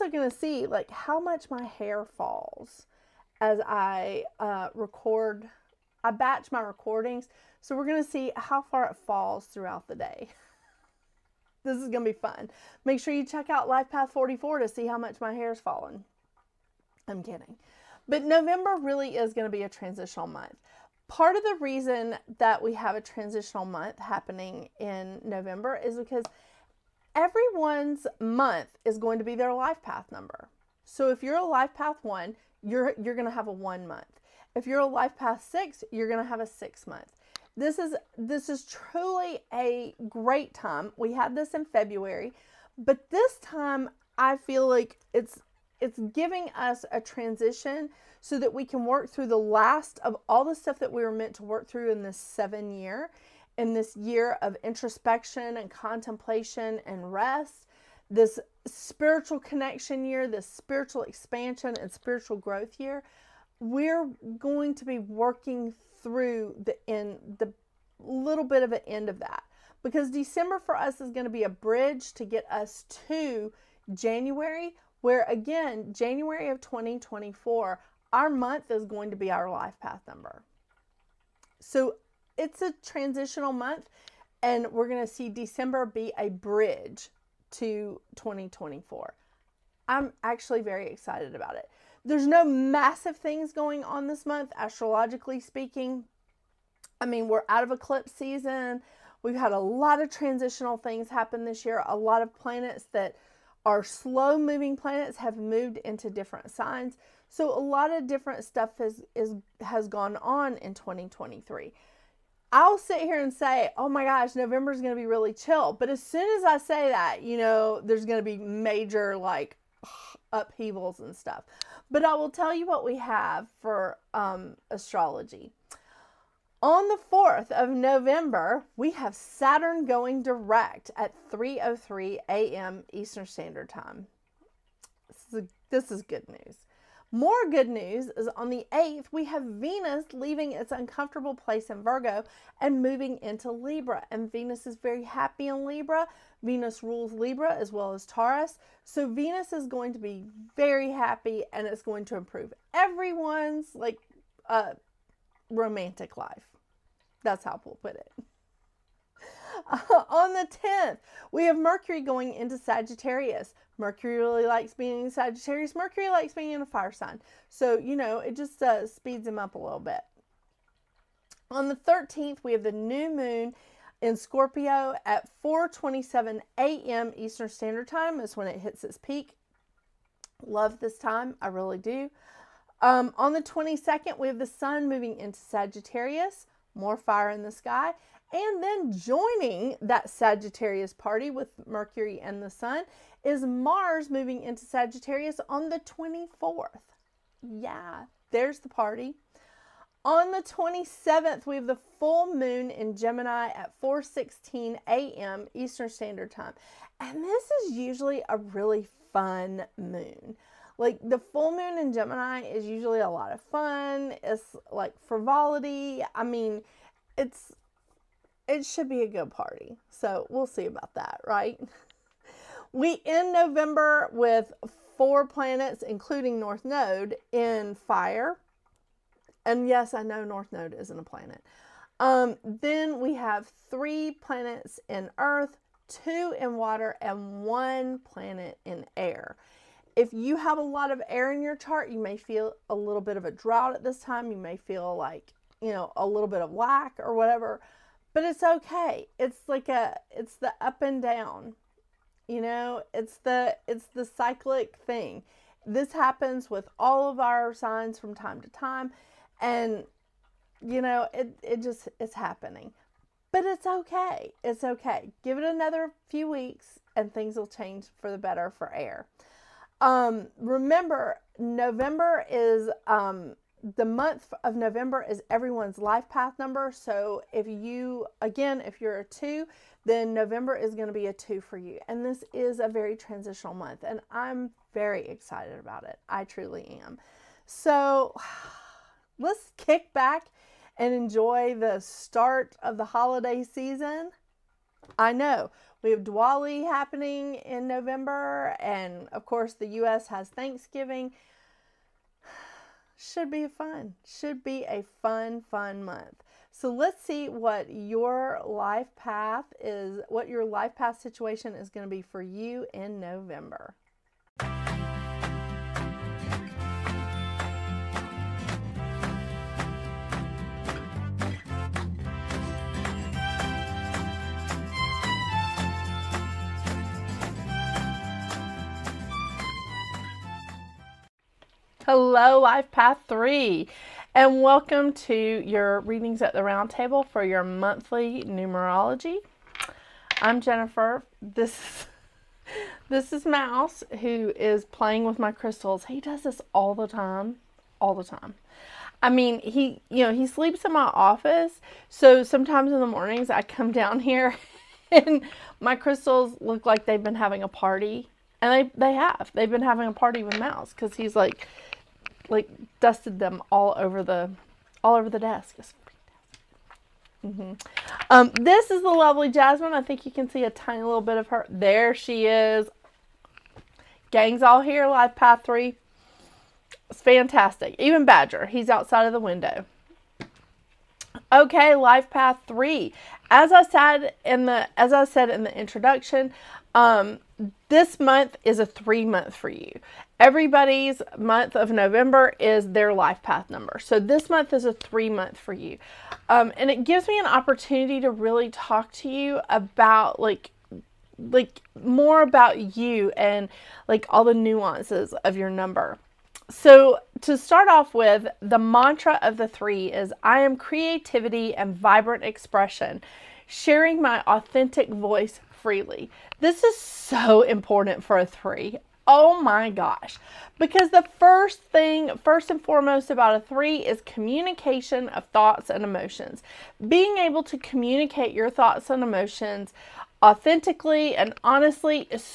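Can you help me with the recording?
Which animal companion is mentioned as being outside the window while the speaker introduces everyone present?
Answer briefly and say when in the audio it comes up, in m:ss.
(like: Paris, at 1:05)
Badger, at 6:18.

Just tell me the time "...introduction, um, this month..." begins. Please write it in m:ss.
6:25.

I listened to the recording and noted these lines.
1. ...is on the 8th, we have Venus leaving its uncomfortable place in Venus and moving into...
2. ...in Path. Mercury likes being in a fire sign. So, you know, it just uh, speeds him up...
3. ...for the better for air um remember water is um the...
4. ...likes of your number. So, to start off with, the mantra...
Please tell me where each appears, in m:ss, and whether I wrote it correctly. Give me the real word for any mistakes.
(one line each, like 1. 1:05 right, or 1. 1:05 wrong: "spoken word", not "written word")
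1. 2:18 wrong: "Virgo", not "Venus"
2. 2:45 wrong: "Sagittarius", not "Path"
3. 4:28 wrong: "november", not "water"
4. 6:44 wrong: "nuances", not "likes".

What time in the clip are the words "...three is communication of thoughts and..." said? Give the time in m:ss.
7:03.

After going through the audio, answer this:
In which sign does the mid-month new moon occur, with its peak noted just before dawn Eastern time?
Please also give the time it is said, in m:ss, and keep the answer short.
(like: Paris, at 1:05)
Scorpio, at 2:54.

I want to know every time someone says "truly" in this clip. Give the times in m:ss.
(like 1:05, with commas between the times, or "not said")
0:38, 4:46.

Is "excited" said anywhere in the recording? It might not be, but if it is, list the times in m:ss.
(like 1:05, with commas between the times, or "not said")
1:30, 4:45.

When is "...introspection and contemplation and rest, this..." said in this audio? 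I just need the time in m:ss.
0:54.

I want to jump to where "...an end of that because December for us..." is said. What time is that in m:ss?
1:08.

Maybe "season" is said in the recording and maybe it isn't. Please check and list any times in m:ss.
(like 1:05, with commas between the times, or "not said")
1:38, 4:53.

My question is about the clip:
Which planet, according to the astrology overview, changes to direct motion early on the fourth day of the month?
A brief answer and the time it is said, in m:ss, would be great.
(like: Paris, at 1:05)
Saturn, at 2:09.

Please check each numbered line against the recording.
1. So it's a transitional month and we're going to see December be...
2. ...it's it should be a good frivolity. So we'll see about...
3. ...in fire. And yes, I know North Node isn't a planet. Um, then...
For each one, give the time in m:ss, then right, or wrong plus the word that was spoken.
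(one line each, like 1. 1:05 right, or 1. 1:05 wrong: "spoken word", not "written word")
1. 1:21 right
2. 3:37 wrong: "party", not "frivolity"
3. 3:47 right.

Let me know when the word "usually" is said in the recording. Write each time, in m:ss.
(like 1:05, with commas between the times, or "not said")
3:27, 3:32.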